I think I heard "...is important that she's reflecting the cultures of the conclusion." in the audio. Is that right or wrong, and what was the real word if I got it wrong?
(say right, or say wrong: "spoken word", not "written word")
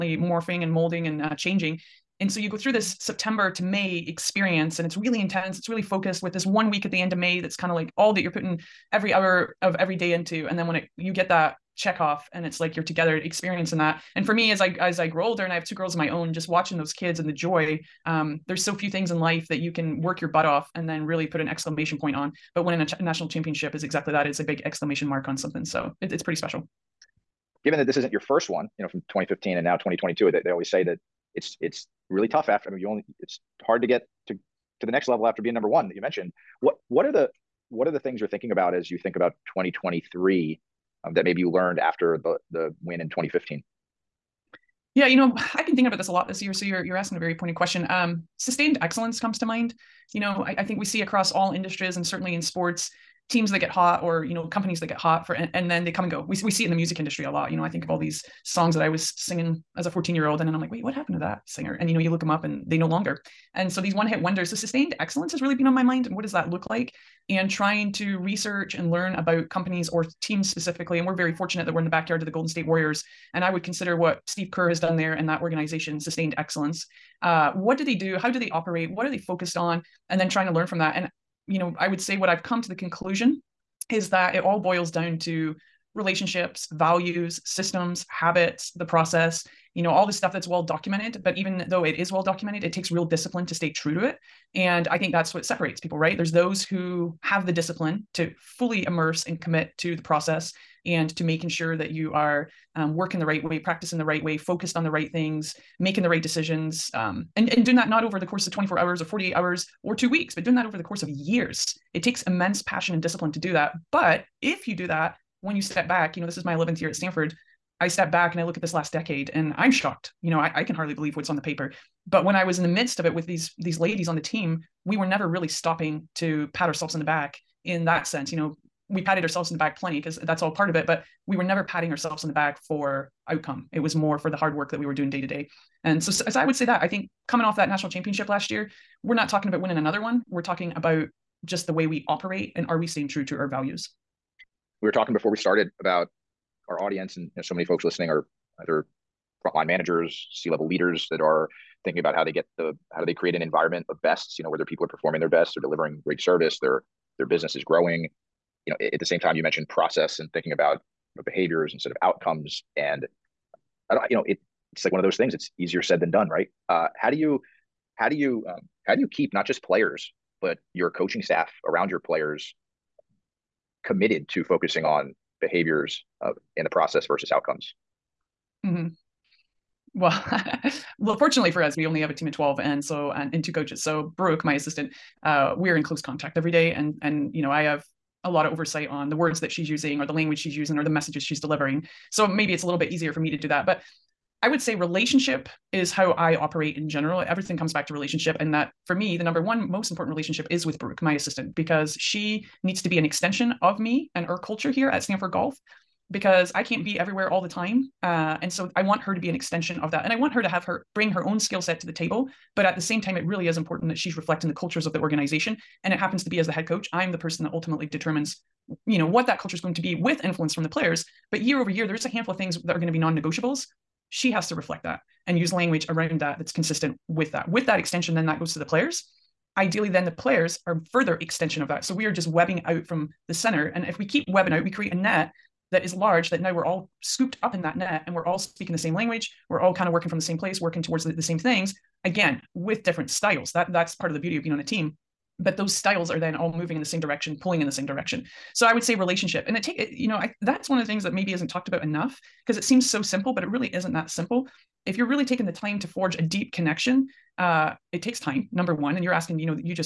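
wrong: "organization", not "conclusion".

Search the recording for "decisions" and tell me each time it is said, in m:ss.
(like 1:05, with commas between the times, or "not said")
1:46.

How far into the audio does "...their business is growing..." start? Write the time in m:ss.
2:37.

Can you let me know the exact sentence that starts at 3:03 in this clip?
So Brooke, my assistant, uh, we're in close contact every day.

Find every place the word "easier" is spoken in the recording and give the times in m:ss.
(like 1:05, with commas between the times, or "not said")
2:45, 3:12.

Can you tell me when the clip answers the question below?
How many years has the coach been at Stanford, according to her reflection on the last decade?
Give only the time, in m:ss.
1:56.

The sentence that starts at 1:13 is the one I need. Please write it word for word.
And I would consider what Steve Kerr has done there and that organization sustained excellence.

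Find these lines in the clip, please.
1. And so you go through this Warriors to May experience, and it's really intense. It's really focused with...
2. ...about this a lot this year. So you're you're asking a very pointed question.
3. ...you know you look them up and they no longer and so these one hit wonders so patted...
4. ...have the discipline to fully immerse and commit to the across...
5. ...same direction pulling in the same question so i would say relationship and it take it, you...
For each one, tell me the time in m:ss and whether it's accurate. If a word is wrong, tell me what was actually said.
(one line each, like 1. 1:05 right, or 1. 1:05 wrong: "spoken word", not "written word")
1. 0:02 wrong: "September", not "Warriors"
2. 0:45 right
3. 1:01 wrong: "sustained", not "patted"
4. 1:37 wrong: "process", not "across"
5. 4:06 wrong: "direction", not "question".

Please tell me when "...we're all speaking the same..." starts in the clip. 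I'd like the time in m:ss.
3:58.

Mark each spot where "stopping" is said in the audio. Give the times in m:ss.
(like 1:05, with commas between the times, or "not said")
2:05.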